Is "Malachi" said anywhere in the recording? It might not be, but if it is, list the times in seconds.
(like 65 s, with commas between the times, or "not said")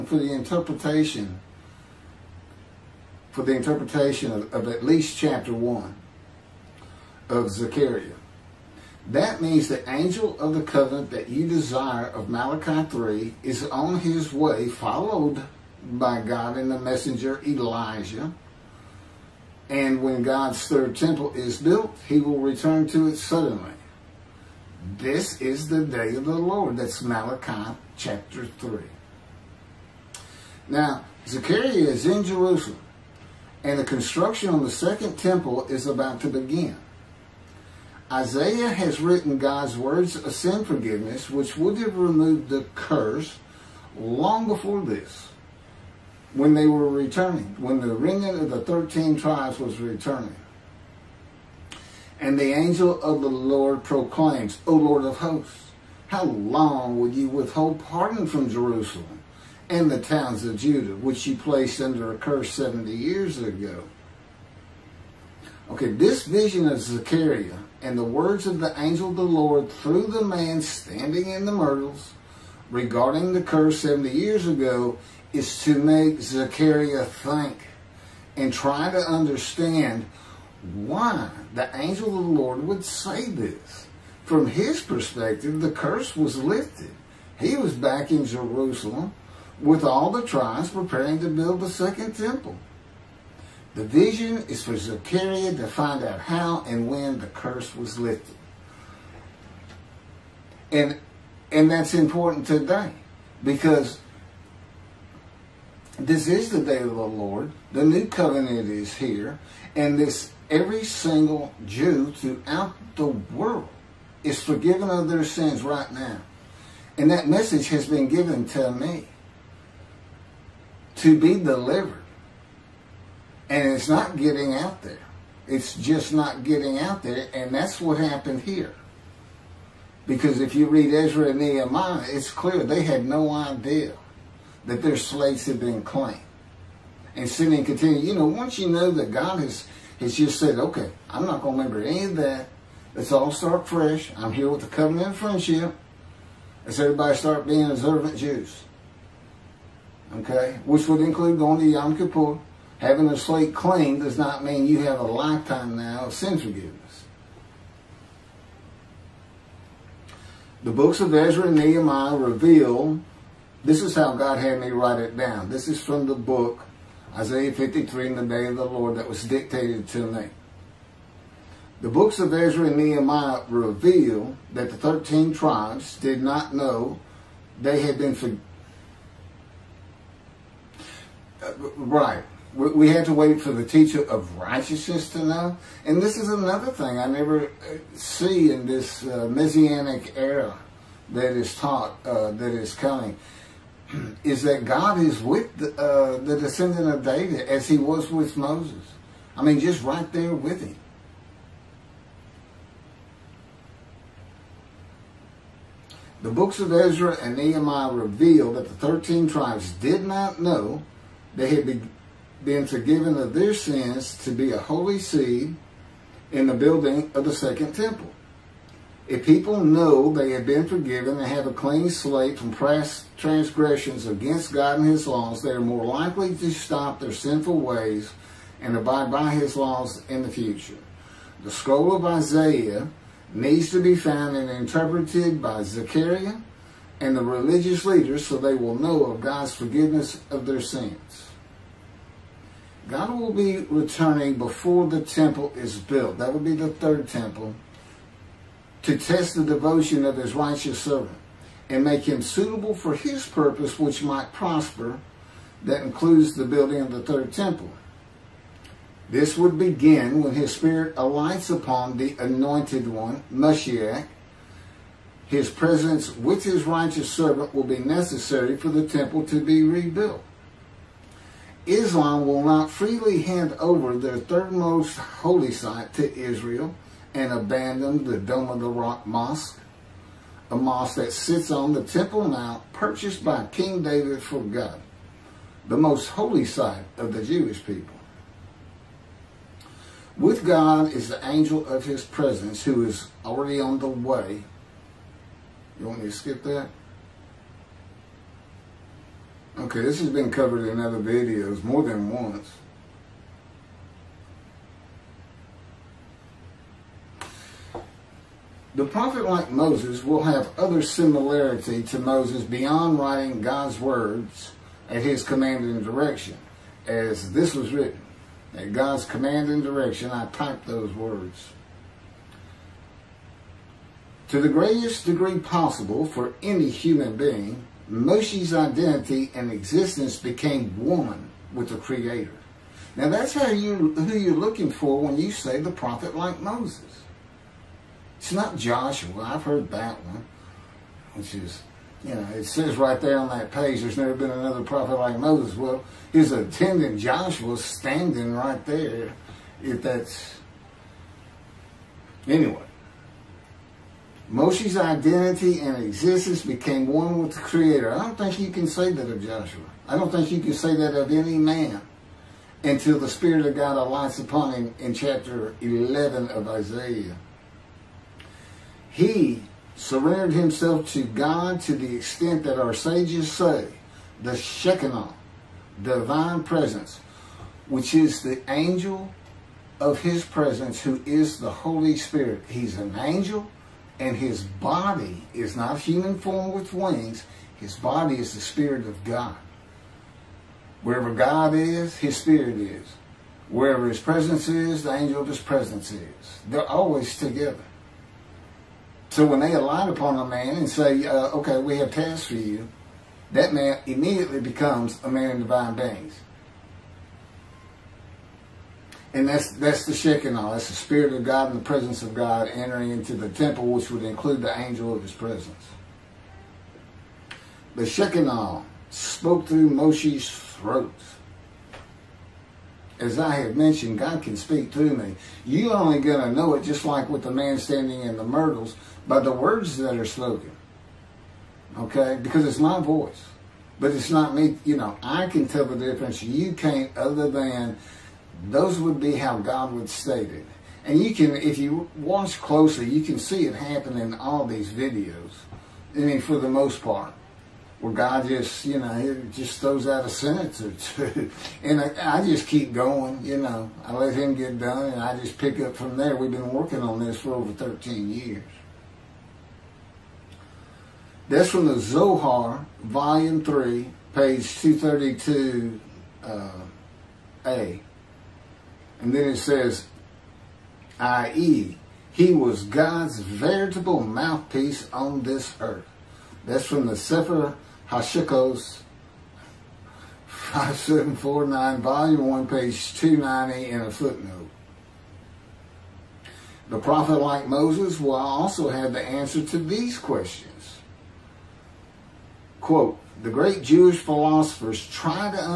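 12 s, 27 s.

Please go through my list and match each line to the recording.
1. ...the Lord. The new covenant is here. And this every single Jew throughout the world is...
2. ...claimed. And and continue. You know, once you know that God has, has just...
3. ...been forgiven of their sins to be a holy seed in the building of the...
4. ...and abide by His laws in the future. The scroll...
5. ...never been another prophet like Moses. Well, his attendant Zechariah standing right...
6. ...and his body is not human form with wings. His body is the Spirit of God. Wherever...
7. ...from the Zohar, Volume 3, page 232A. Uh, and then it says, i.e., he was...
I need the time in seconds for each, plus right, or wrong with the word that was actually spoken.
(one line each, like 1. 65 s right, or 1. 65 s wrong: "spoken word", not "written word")
1. 106 s right
2. 135 s right
3. 212 s right
4. 228 s right
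5. 343 s wrong: "Joshua", not "Zechariah"
6. 384 s right
7. 461 s right.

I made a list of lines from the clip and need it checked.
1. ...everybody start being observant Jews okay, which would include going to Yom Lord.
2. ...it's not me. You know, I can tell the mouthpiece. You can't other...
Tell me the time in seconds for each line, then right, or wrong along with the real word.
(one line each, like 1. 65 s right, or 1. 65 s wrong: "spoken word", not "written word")
1. 146 s wrong: "Kippur", not "Lord"
2. 433 s wrong: "difference", not "mouthpiece".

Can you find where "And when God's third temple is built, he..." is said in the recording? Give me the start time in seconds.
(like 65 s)
19 s.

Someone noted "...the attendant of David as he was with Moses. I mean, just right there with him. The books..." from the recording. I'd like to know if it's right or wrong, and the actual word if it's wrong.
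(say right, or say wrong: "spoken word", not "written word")
wrong: "descendant", not "attendant".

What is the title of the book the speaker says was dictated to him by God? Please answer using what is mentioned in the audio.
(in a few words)
Isaiah 53 in the day of the Lord.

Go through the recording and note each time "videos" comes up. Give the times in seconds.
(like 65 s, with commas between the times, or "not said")
300 s, 444 s.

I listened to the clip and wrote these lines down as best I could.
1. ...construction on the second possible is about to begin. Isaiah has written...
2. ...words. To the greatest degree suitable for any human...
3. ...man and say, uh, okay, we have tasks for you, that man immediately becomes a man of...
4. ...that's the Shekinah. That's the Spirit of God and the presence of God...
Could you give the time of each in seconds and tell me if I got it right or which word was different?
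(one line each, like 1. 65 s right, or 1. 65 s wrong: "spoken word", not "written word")
1. 33 s wrong: "temple", not "possible"
2. 320 s wrong: "possible", not "suitable"
3. 400 s right
4. 409 s right.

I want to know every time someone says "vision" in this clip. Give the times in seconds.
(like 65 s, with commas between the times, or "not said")
66 s, 93 s.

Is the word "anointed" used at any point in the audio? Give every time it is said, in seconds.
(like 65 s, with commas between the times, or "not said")
262 s.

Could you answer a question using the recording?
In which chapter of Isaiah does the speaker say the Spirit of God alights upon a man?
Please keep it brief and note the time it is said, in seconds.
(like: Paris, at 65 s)
Chapter 11, at 364 s.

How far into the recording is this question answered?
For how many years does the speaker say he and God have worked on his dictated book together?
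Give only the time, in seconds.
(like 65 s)
457 s.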